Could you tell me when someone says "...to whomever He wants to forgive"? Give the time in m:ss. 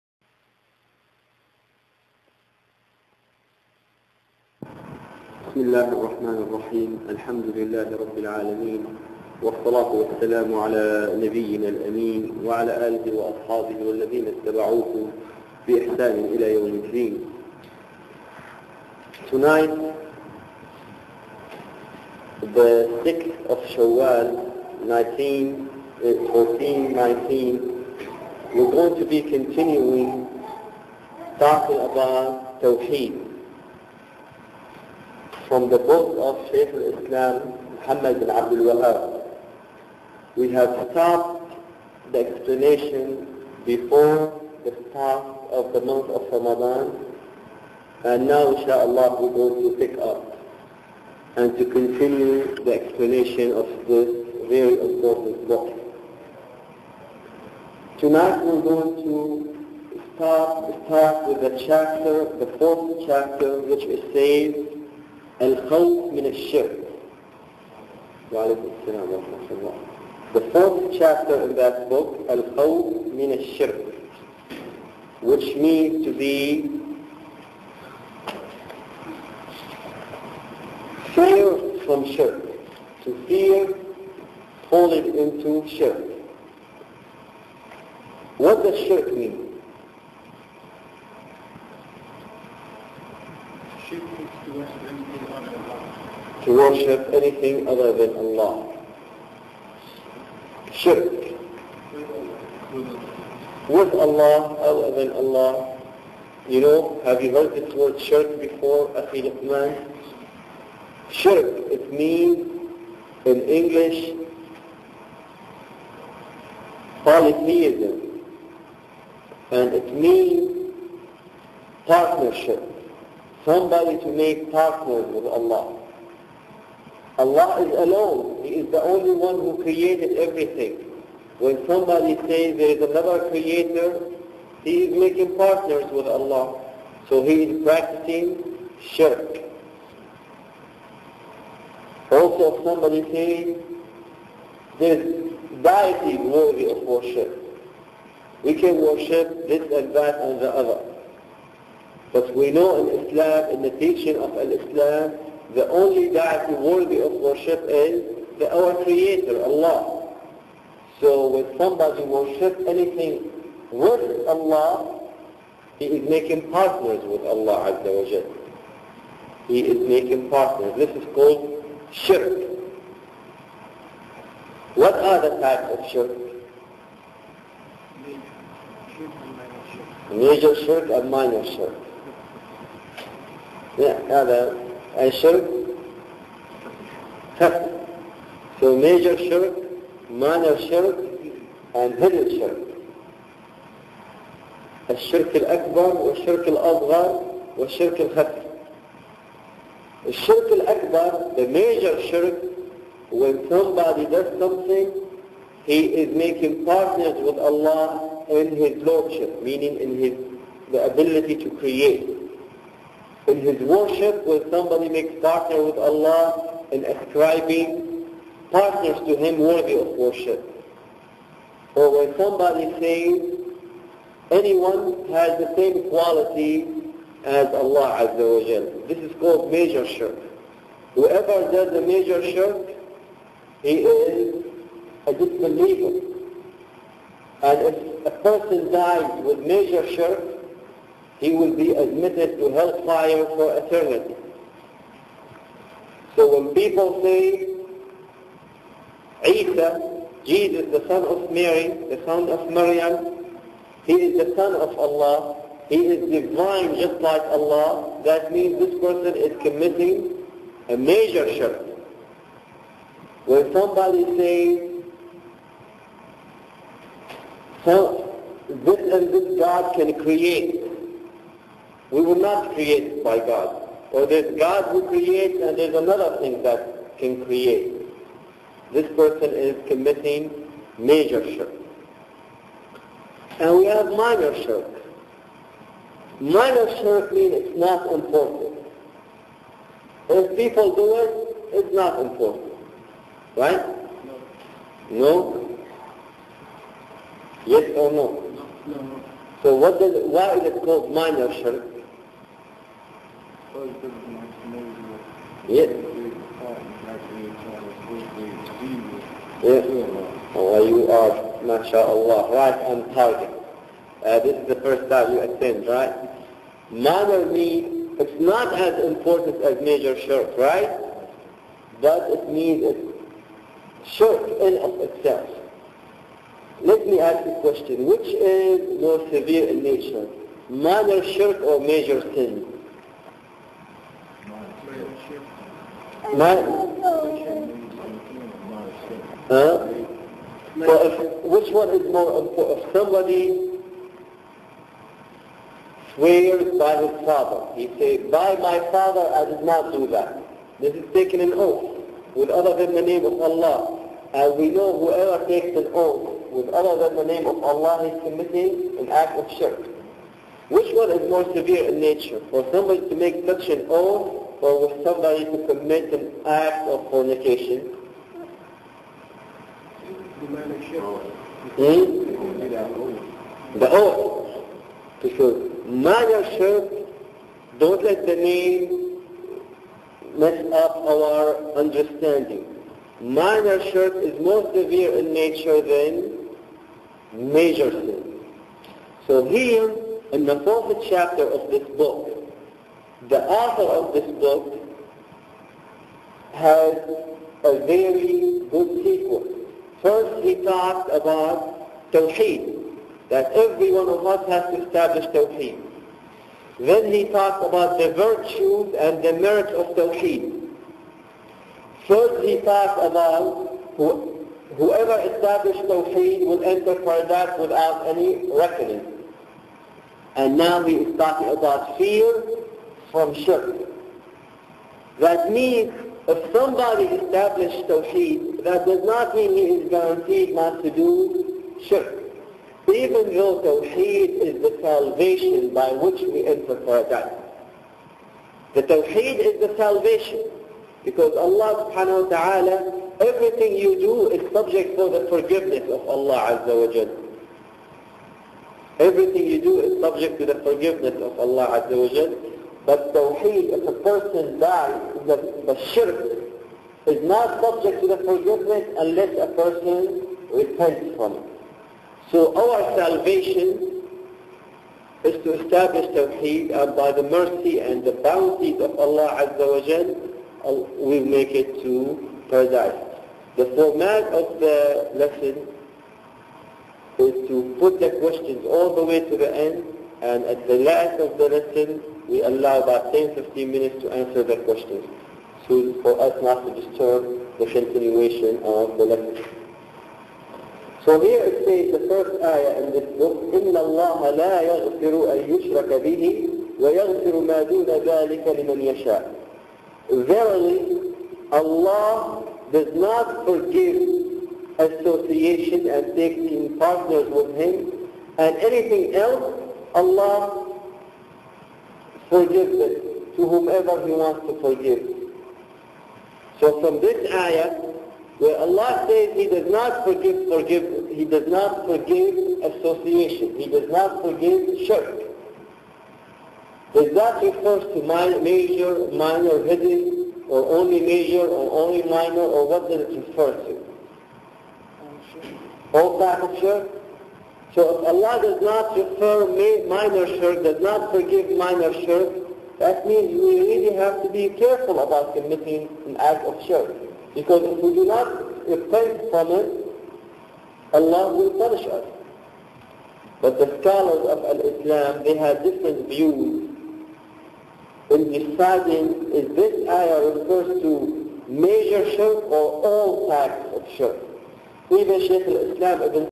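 8:33.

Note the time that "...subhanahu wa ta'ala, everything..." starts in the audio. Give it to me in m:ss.
7:21.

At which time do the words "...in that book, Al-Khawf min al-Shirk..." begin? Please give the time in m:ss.
1:11.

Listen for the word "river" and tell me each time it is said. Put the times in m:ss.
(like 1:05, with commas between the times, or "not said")
not said.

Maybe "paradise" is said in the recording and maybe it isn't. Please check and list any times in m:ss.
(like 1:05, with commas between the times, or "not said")
6:56, 7:16, 7:52.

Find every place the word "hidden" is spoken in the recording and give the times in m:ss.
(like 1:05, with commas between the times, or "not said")
3:11, 8:49.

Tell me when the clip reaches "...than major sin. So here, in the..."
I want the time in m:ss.
6:25.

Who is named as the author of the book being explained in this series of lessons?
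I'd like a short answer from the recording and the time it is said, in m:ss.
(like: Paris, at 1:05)
Muhammad bin Abdul Wahab, at 0:37.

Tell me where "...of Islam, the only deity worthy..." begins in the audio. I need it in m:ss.
2:34.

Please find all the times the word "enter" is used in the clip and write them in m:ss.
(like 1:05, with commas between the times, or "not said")
6:56, 7:16.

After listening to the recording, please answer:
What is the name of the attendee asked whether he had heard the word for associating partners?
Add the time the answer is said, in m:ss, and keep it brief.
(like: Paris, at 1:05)
Luqman, at 1:49.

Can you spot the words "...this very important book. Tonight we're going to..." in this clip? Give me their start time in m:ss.
0:53.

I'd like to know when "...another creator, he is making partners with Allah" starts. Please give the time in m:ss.
2:12.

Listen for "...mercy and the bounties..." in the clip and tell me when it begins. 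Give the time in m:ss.
7:47.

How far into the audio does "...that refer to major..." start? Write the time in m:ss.
8:46.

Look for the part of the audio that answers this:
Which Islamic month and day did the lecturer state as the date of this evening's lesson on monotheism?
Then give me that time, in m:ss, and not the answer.
0:23.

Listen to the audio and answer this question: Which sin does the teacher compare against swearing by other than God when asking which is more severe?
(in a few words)
fornication.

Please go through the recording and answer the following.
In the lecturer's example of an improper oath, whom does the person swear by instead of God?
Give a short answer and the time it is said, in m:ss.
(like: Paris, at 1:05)
his father, at 5:46.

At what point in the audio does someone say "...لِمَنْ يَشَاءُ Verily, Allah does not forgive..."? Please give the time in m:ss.
8:18.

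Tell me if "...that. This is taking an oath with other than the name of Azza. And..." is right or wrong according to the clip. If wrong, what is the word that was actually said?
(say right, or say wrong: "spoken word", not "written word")
wrong: "Allah", not "Azza".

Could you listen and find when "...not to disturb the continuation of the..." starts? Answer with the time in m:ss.
8:06.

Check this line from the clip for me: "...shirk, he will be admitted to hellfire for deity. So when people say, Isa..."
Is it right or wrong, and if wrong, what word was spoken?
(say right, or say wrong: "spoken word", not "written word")
wrong: "eternity", not "deity".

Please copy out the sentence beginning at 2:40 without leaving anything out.
So when somebody worship anything with Allah, he is making partners with Allah Azza wa Jal.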